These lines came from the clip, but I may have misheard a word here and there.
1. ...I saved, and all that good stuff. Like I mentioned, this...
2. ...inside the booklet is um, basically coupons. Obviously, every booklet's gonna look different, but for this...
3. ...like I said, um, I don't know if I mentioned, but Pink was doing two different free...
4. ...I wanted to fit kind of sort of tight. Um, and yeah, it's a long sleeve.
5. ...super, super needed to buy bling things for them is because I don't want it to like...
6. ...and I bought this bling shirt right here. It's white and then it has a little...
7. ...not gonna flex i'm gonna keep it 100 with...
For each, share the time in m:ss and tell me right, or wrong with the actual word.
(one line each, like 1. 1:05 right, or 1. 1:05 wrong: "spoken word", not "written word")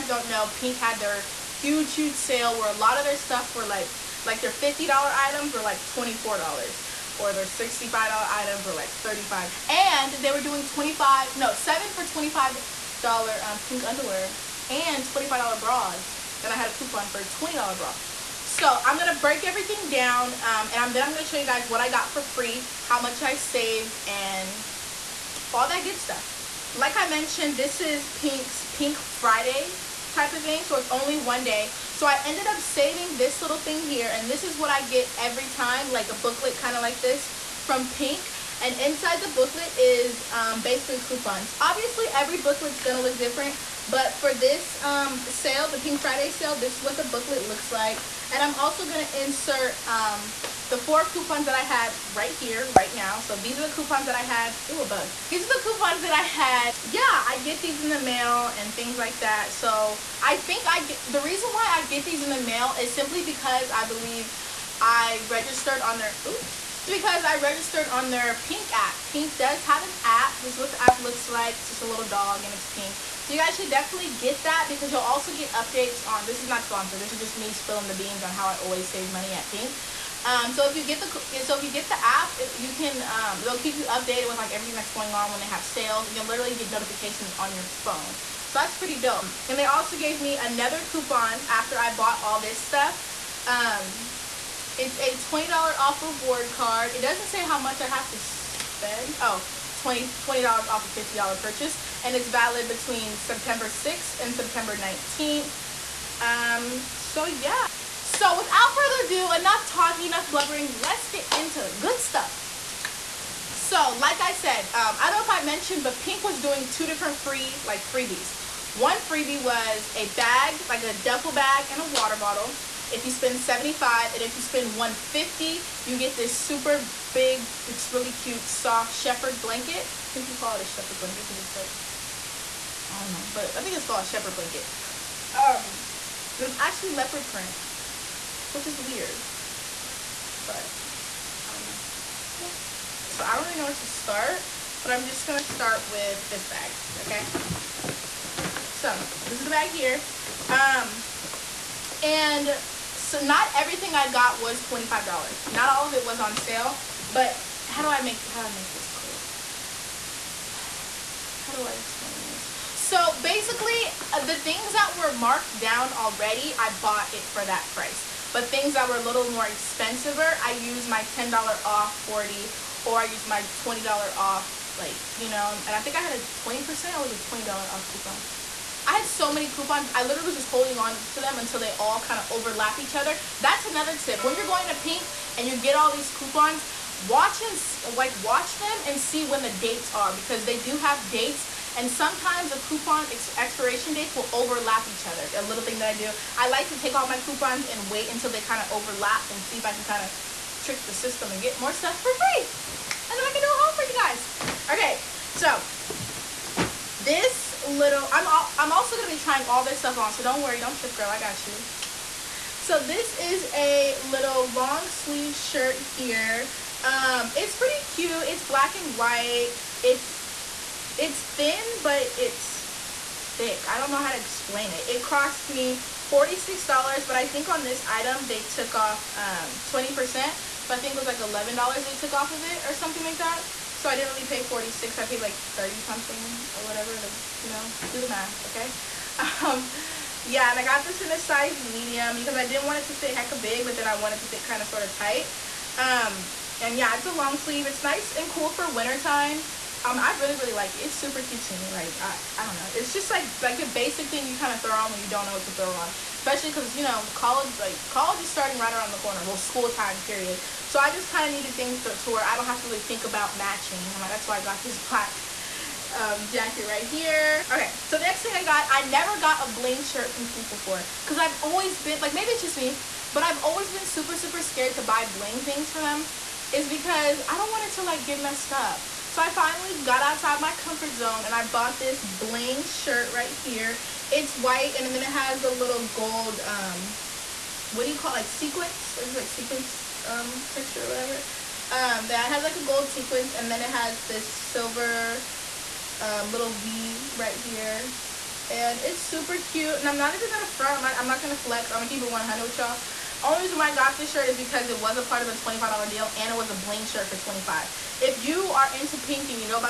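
1. 0:23 right
2. 0:38 right
3. 1:53 right
4. 4:03 right
5. 4:33 wrong: "scared", not "needed"
6. 4:41 right
7. 5:01 right.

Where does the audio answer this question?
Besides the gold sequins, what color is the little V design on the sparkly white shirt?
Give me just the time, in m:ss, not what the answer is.
4:54.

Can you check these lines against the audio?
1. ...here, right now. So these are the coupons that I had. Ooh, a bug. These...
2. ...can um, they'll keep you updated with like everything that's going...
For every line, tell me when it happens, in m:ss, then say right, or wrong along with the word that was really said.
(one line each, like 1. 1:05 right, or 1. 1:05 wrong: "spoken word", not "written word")
1. 0:52 right
2. 1:22 right.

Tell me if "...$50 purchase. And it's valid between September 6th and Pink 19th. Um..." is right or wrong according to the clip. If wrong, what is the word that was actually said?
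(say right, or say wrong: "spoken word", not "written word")
wrong: "September", not "Pink".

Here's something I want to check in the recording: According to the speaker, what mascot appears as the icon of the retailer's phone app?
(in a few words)
a little dog.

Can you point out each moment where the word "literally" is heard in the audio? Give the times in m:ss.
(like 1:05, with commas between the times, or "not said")
1:26, 3:00.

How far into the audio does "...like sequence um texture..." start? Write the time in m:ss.
4:49.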